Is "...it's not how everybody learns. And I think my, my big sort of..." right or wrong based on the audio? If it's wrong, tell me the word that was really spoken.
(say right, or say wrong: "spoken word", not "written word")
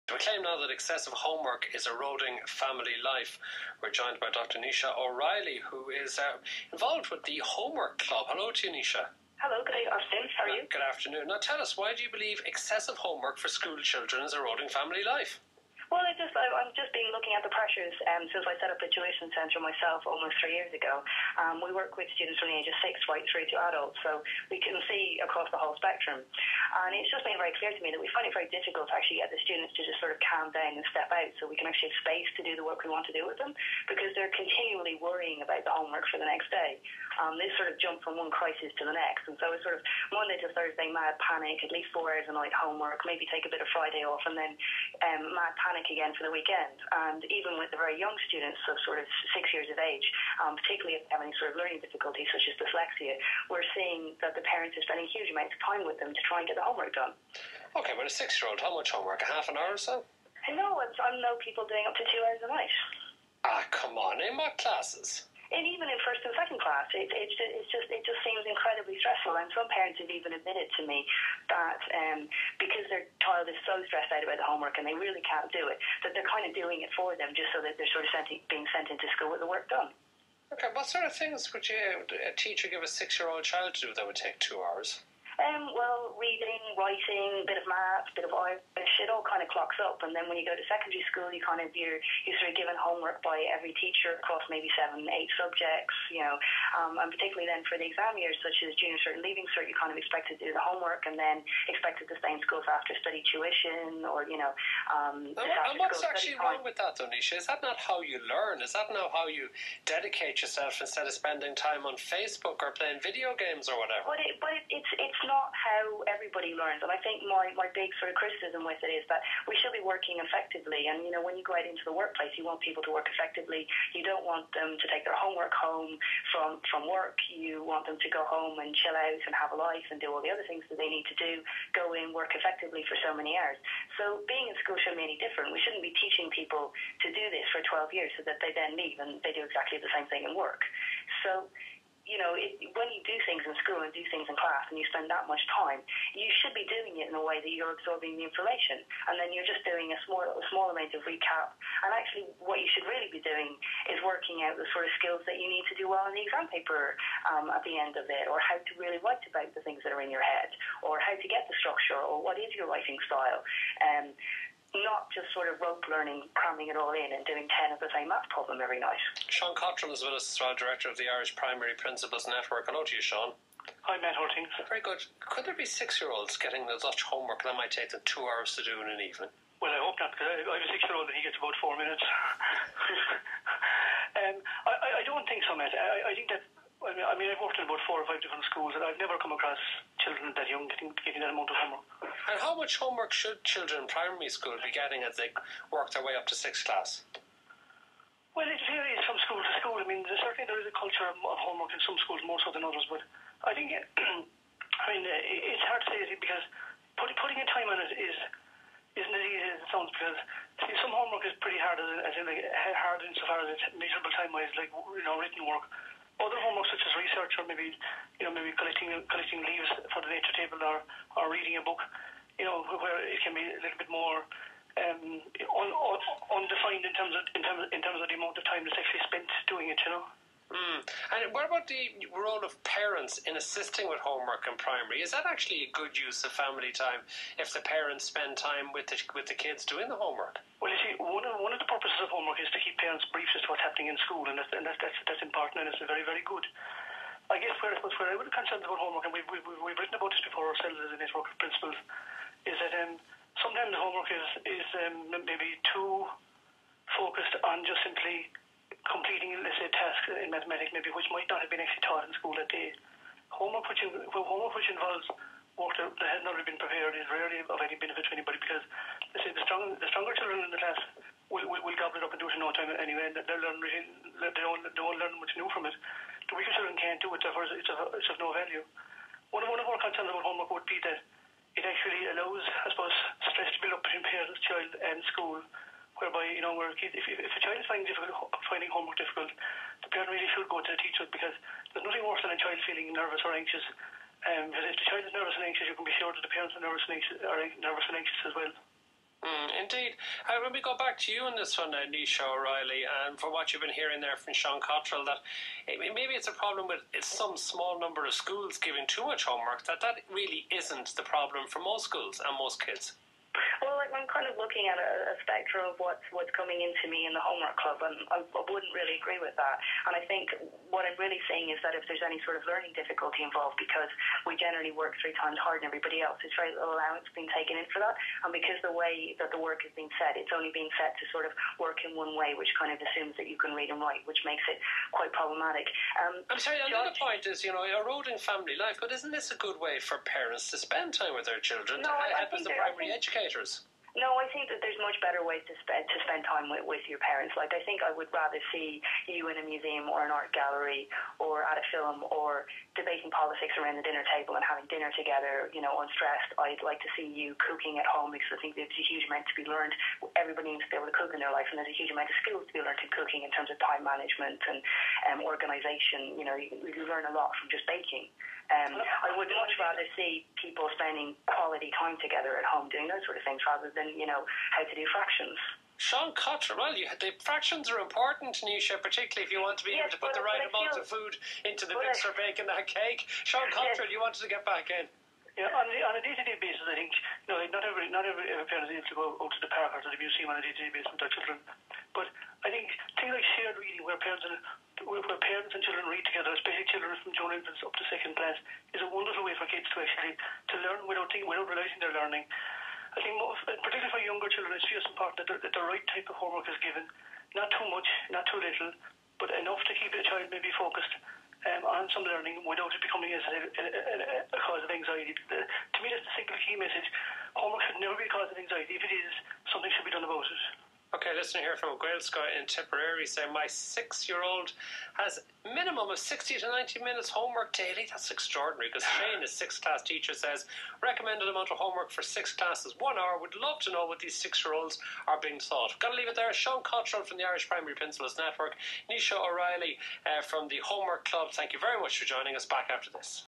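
right.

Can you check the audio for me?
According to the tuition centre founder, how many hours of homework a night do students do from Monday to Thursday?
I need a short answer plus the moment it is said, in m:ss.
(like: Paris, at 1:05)
At least 4 hours, at 0:41.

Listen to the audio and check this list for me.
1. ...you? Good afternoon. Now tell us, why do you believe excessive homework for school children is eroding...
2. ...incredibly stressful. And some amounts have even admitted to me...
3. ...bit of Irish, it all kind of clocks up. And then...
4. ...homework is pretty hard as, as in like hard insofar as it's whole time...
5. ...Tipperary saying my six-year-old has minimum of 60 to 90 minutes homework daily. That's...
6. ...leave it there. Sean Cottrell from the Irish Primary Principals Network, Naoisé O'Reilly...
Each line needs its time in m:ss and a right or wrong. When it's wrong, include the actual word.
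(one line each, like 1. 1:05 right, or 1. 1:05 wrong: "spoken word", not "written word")
1. 0:10 right
2. 1:08 wrong: "parents", not "amounts"
3. 1:28 right
4. 3:30 wrong: "measurable", not "whole"
5. 7:02 right
6. 7:15 right.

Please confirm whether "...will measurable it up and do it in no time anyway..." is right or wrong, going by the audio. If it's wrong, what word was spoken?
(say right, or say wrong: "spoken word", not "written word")
wrong: "gobble", not "measurable".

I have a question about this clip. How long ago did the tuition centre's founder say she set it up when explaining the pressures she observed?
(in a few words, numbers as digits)
Almost 3 years.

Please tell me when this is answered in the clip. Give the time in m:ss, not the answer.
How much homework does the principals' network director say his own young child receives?
3:01.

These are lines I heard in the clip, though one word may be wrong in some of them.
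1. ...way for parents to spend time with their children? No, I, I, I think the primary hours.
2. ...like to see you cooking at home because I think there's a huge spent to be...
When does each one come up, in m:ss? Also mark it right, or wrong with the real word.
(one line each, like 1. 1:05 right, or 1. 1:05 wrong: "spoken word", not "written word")
1. 5:39 wrong: "educators", not "hours"
2. 5:56 wrong: "amount", not "spent".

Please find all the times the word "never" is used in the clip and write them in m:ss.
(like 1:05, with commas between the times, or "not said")
3:08, 6:57.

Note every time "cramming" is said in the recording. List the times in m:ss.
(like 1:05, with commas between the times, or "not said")
2:46.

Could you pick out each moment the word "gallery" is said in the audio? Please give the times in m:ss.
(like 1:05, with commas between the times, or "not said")
5:50.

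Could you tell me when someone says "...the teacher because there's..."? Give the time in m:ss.
4:50.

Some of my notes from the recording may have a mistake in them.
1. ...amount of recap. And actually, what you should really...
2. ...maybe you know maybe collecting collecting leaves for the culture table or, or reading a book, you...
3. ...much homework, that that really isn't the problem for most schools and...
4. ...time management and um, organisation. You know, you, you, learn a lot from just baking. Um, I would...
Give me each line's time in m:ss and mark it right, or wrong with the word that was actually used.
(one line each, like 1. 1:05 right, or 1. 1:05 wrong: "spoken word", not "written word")
1. 2:30 right
2. 3:37 wrong: "nature", not "culture"
3. 5:09 right
4. 6:03 right.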